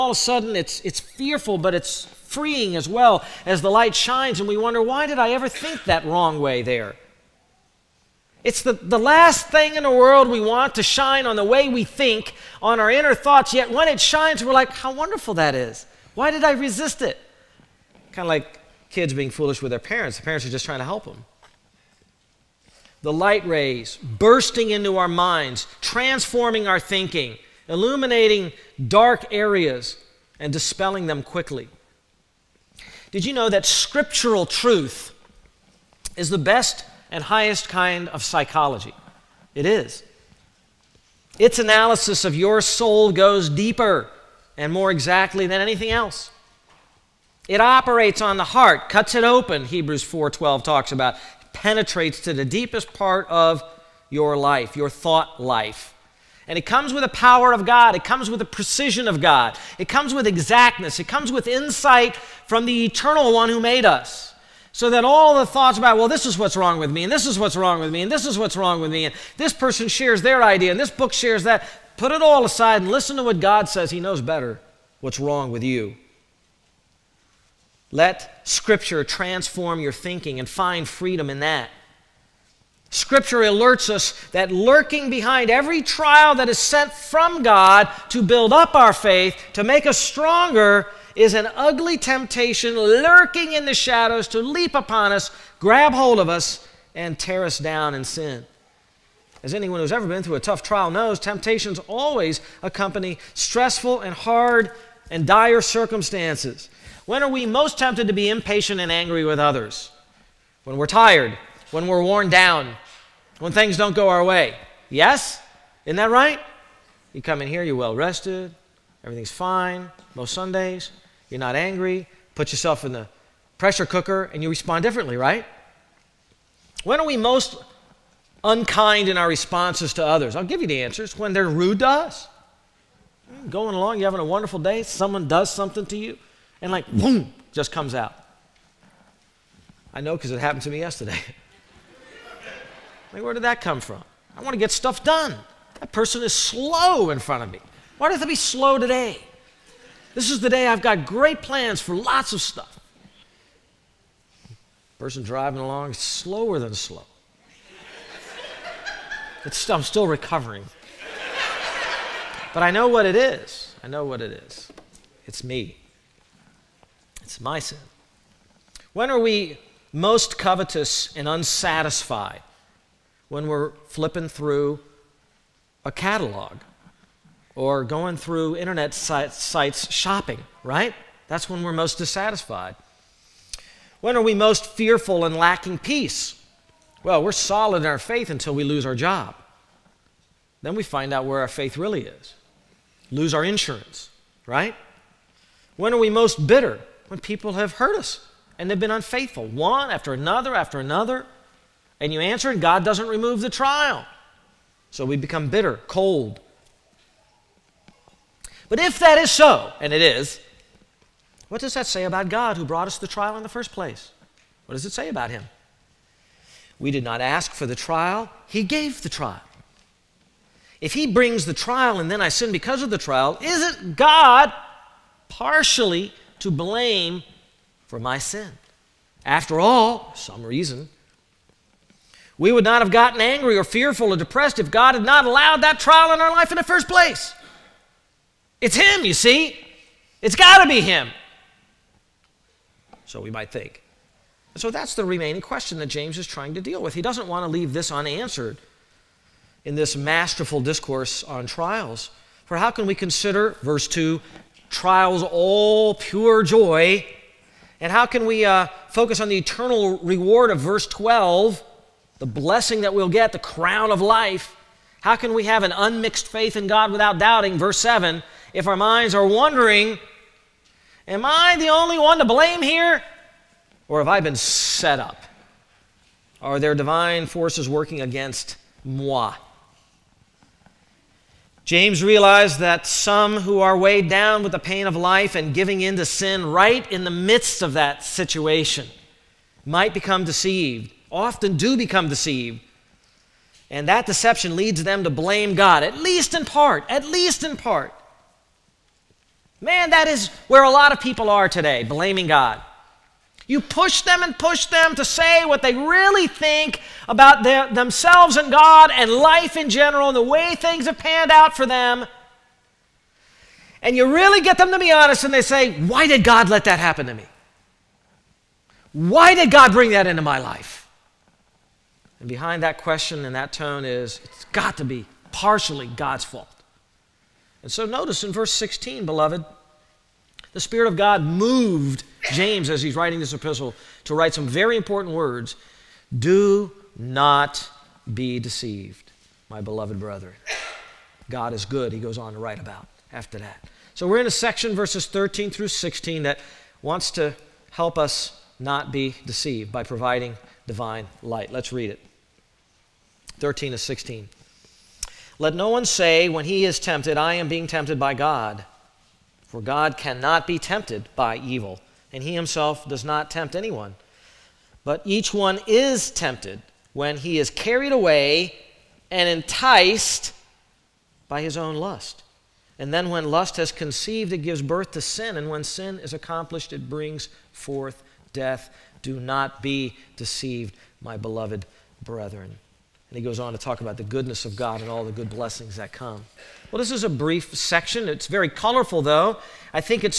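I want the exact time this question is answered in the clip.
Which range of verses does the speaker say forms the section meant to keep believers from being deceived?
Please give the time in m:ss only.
5:44.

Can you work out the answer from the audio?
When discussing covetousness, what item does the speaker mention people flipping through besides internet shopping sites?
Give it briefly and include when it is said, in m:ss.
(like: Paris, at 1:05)
a catalog, at 2:55.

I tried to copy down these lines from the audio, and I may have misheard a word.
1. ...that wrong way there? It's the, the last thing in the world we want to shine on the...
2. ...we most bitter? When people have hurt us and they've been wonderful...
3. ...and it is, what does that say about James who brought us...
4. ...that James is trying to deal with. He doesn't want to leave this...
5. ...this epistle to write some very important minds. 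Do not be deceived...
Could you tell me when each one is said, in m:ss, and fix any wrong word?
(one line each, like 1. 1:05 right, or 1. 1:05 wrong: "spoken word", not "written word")
1. 0:05 right
2. 3:15 wrong: "unfaithful", not "wonderful"
3. 3:29 wrong: "God", not "James"
4. 4:05 right
5. 5:33 wrong: "words", not "minds".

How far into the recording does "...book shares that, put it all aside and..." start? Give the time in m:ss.
1:10.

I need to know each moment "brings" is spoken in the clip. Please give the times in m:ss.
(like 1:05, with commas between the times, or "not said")
3:41, 5:19, 6:16.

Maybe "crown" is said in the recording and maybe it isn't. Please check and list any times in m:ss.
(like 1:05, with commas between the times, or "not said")
4:23.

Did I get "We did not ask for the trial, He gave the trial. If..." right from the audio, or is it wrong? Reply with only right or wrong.
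right.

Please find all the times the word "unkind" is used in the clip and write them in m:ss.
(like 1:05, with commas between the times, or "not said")
2:08.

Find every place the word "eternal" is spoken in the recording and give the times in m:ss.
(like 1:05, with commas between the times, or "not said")
1:02, 4:19.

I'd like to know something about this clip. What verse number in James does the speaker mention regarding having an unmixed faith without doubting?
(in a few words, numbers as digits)
7.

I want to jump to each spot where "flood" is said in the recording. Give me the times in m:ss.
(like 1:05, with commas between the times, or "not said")
not said.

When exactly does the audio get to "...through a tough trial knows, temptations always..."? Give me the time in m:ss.
1:40.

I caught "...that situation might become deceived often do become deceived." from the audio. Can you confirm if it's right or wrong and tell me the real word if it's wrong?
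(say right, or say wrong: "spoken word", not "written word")
right.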